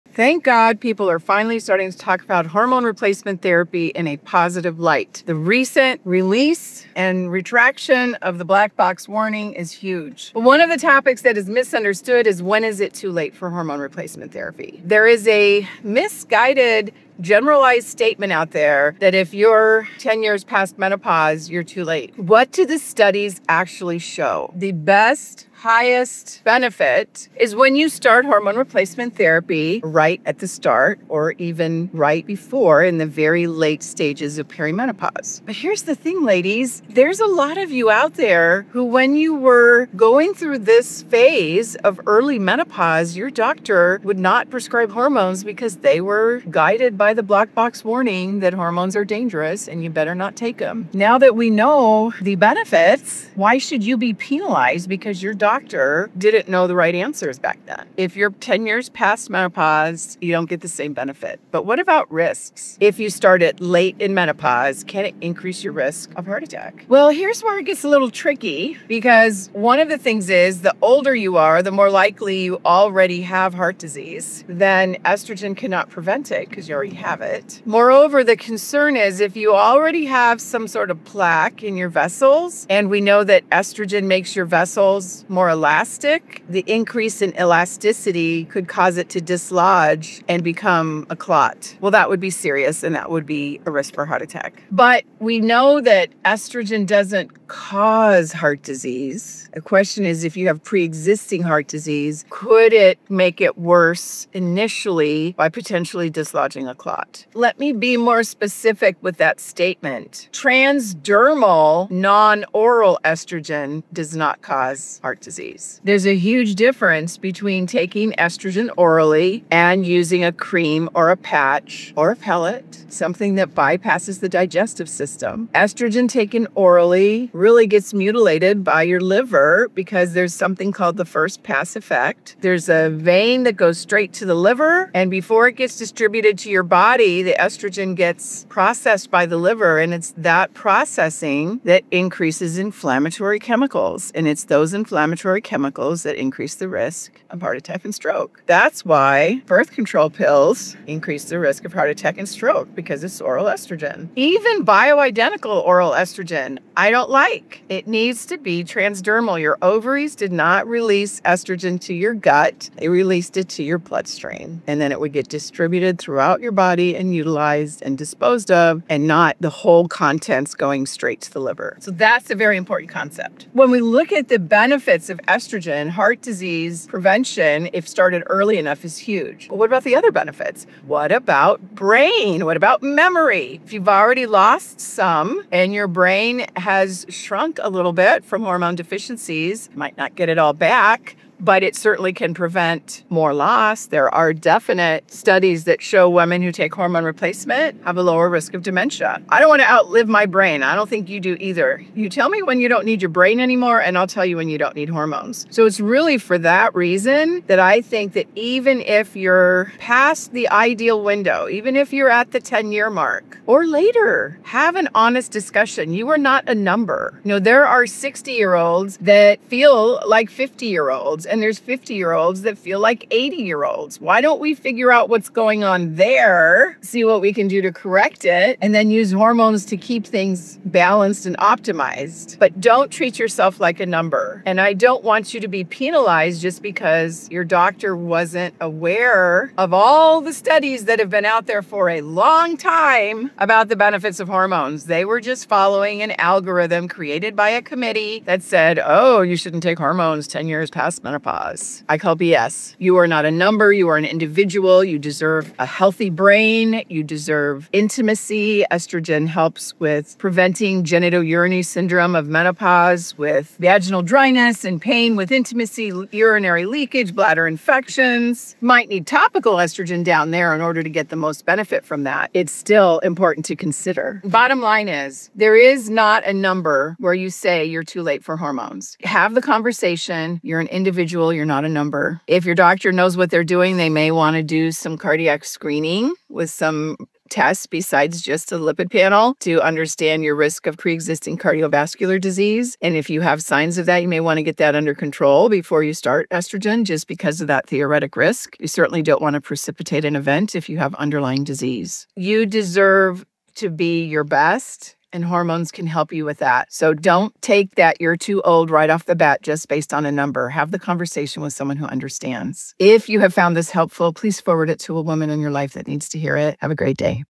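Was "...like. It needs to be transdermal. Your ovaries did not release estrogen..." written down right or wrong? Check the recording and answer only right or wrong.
right.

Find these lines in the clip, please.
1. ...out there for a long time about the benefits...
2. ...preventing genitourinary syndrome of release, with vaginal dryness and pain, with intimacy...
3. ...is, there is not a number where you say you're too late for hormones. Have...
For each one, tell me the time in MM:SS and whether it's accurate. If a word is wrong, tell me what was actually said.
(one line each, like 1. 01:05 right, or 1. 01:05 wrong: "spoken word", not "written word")
1. 04:01 right
2. 04:20 wrong: "menopause", not "release"
3. 04:34 right.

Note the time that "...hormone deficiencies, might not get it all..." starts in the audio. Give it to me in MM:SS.
03:08.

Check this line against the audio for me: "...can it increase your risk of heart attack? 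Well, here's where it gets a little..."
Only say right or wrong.
right.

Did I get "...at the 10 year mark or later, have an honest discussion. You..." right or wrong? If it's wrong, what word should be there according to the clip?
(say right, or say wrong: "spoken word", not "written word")
right.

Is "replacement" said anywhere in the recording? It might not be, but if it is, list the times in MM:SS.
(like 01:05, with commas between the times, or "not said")
00:02, 00:13, 00:28, 03:17.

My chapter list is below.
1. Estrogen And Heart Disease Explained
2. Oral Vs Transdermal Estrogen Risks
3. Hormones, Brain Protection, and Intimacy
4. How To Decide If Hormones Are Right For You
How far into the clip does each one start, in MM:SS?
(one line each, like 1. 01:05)
1. 01:03
2. 01:50
3. 03:01
4. 04:35.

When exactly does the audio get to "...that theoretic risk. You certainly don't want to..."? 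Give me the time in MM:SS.
04:57.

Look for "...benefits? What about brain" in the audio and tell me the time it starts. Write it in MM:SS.
03:00.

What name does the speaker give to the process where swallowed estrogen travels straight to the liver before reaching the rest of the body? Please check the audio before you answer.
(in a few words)
first pass effect.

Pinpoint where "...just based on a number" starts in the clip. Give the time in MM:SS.
05:09.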